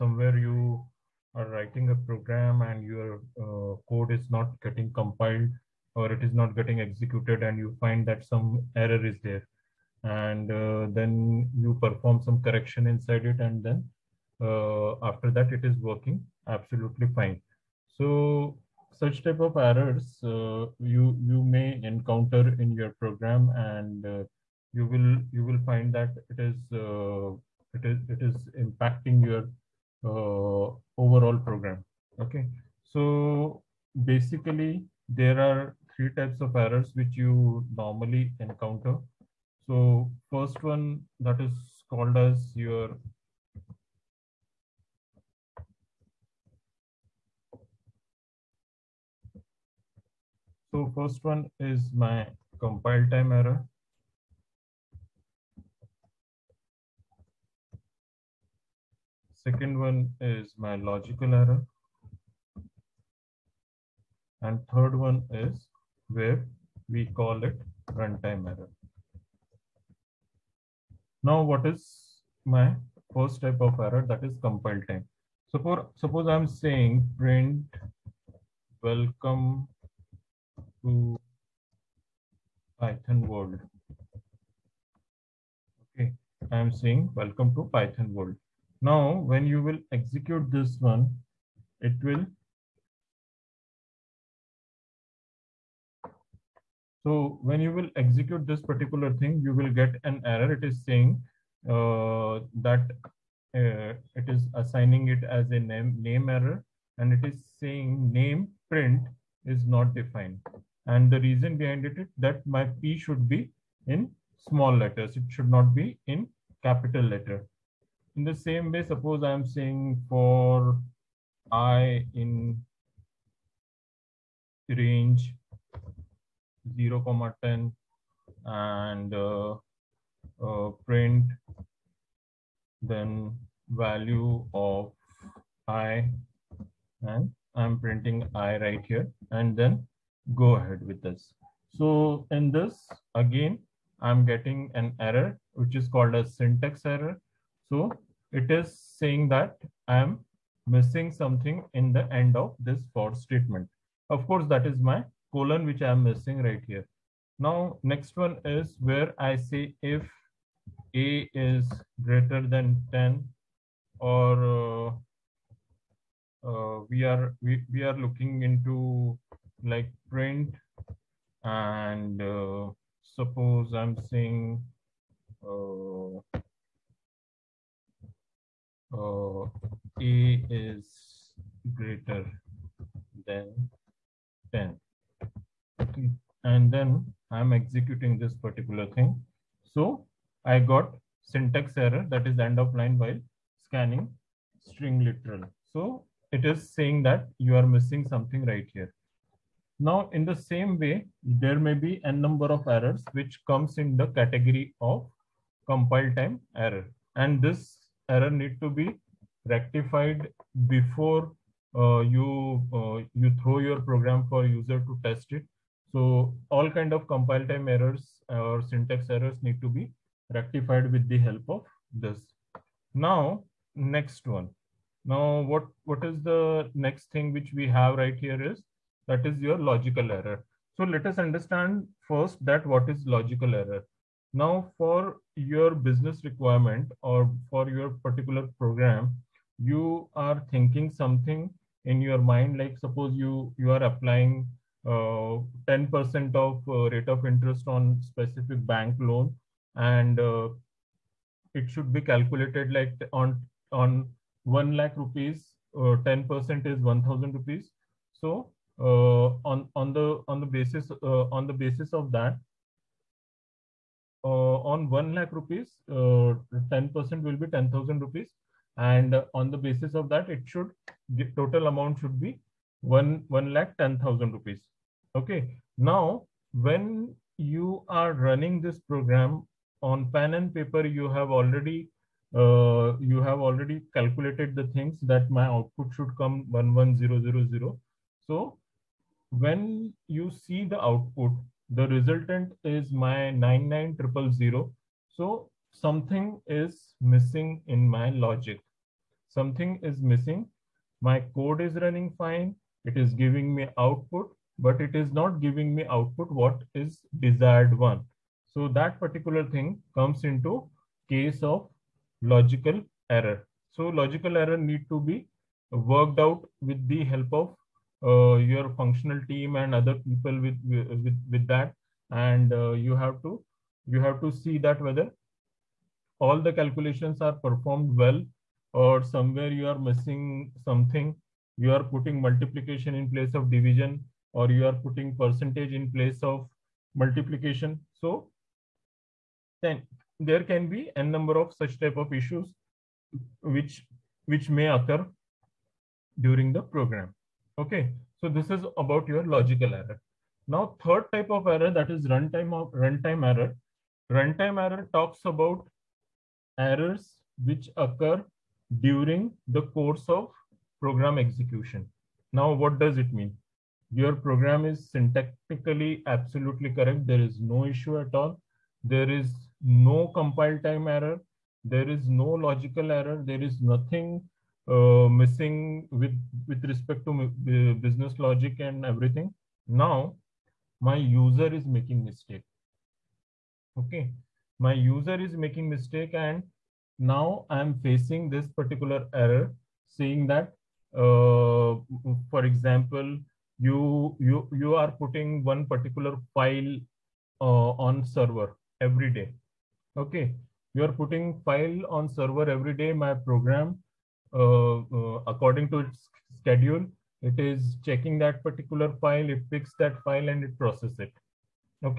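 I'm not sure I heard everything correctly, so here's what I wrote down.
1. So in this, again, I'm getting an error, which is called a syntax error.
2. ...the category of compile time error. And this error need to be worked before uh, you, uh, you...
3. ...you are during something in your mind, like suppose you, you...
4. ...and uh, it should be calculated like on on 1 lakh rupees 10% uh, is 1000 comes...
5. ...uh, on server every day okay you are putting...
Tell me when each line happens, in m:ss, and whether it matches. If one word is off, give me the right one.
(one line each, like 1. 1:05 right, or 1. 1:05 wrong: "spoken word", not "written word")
1. 2:21 right
2. 3:23 wrong: "rectified", not "worked"
3. 3:59 wrong: "thinking", not "during"
4. 4:09 wrong: "rupees", not "comes"
5. 6:37 right.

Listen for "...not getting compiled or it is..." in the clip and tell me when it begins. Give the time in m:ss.
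0:04.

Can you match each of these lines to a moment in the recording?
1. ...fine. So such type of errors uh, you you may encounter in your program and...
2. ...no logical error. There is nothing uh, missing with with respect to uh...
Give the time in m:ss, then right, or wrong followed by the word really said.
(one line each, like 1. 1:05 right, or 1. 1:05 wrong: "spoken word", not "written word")
1. 0:17 right
2. 6:12 right.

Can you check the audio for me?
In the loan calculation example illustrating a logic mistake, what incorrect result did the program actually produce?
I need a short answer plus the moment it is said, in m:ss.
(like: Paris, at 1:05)
99000, at 4:53.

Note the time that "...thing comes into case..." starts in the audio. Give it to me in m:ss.
5:09.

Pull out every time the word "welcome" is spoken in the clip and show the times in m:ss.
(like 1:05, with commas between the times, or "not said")
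1:18, 1:27.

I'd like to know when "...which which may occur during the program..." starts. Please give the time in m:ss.
5:43.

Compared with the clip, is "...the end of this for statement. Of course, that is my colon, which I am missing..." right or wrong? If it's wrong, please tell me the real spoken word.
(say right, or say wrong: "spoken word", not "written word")
right.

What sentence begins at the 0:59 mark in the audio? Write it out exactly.
Second one is my logical error.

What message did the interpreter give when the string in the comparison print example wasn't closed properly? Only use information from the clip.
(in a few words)
end of line while scanning string literal.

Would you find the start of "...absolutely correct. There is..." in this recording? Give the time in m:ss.
6:06.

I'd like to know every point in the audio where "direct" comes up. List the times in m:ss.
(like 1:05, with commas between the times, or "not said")
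not said.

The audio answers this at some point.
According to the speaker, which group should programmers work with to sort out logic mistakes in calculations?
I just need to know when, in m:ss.
5:18.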